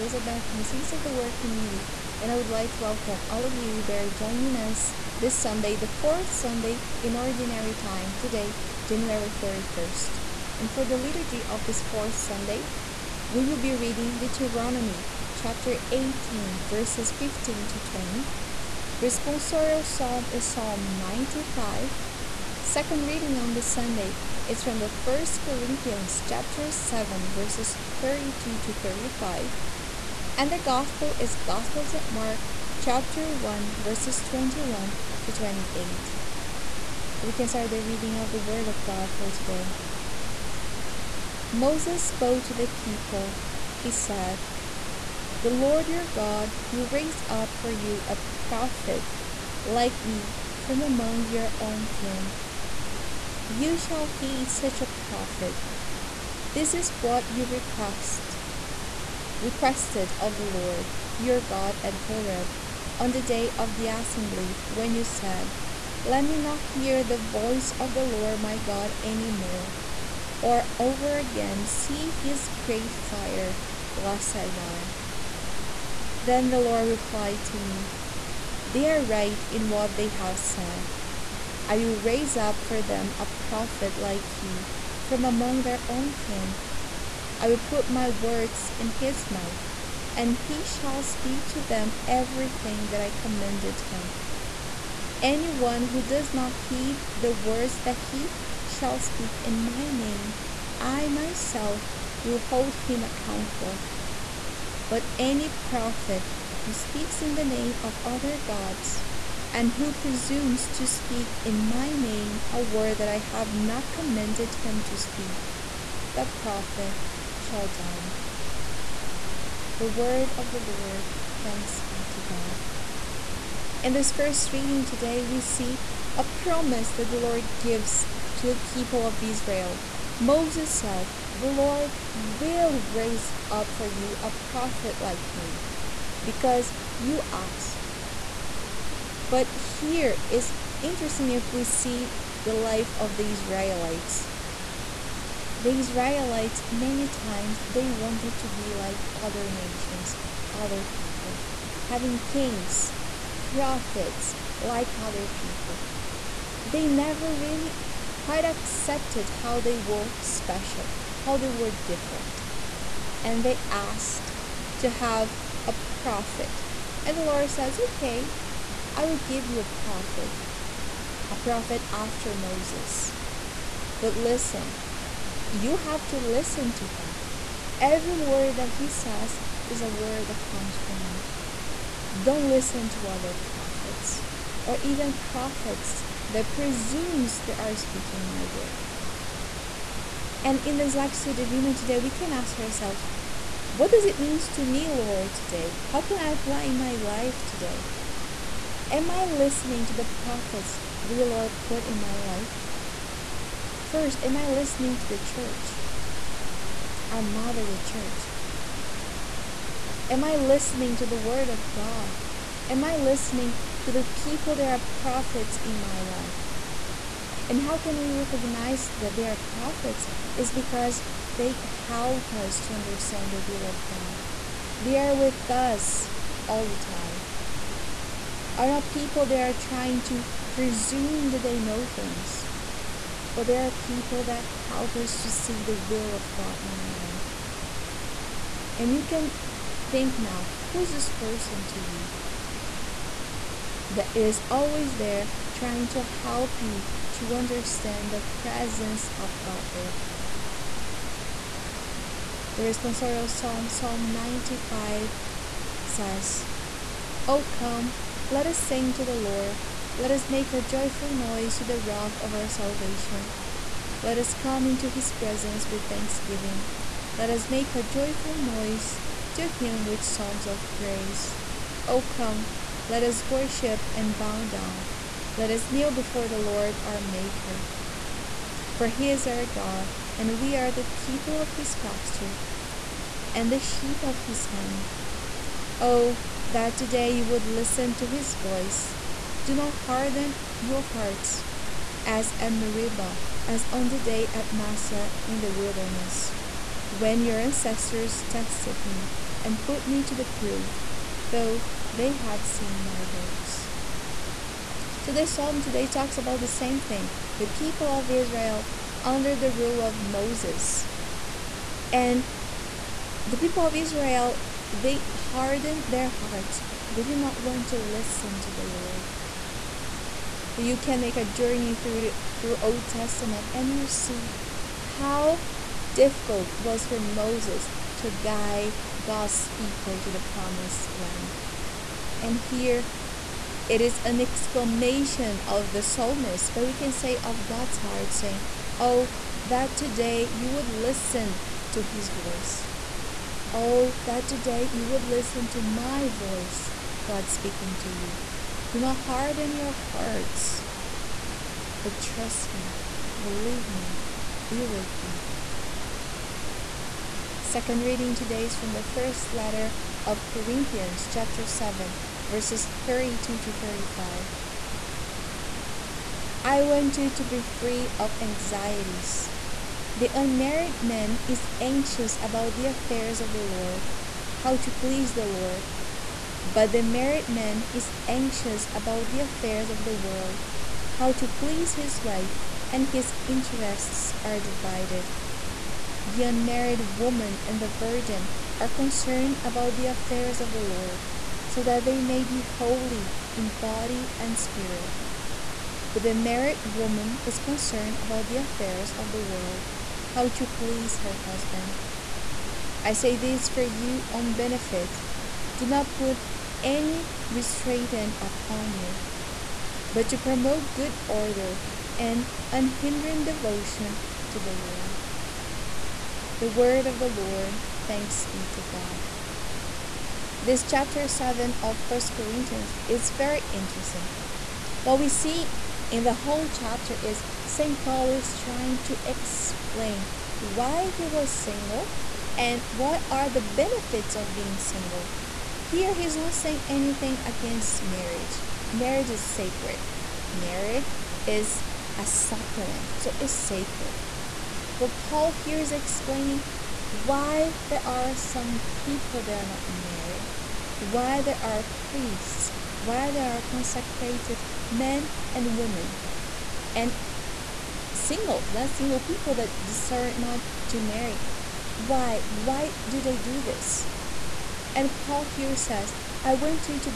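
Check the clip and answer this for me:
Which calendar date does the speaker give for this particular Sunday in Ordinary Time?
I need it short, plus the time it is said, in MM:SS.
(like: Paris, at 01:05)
January 31, at 00:08.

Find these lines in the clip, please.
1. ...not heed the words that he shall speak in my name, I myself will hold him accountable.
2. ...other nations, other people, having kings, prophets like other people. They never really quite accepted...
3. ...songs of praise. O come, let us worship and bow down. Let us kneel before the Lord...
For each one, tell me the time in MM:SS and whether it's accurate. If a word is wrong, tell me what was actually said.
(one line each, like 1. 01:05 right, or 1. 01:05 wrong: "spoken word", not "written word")
1. 01:36 right
2. 02:29 right
3. 04:30 right.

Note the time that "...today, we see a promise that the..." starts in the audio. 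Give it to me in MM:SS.
02:04.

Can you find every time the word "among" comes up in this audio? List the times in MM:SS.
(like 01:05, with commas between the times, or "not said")
00:50, 01:25.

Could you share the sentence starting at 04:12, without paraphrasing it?
The responsorial psalm, Psalm 95, says, Oh, come let us sing to the Lord.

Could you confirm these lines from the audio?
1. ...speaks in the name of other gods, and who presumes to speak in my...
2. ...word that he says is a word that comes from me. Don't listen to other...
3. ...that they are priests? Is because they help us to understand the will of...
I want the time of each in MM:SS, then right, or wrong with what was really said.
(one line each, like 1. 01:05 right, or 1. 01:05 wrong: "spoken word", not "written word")
1. 01:46 right
2. 02:58 right
3. 03:38 wrong: "prophets", not "priests".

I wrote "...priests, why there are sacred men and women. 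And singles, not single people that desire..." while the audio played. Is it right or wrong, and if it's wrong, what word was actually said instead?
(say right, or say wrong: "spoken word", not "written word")
wrong: "consecrated", not "sacred".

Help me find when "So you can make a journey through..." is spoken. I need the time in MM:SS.
05:20.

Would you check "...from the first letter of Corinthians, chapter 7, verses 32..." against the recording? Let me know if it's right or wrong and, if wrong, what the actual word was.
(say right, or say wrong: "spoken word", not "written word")
right.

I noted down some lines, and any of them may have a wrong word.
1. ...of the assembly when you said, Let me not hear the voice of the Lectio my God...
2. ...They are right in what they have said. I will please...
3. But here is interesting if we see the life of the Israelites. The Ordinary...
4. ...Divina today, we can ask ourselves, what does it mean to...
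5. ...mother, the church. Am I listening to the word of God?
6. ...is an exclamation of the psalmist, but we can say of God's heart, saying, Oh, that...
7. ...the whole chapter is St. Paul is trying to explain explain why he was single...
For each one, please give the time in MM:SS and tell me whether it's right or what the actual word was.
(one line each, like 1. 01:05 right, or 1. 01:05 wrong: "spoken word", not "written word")
1. 01:03 wrong: "Lord", not "Lectio"
2. 01:18 wrong: "raise", not "please"
3. 02:19 wrong: "Israelites", not "Ordinary"
4. 03:11 right
5. 03:27 right
6. 05:33 right
7. 07:06 right.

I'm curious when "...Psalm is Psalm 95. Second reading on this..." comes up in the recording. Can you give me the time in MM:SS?
00:19.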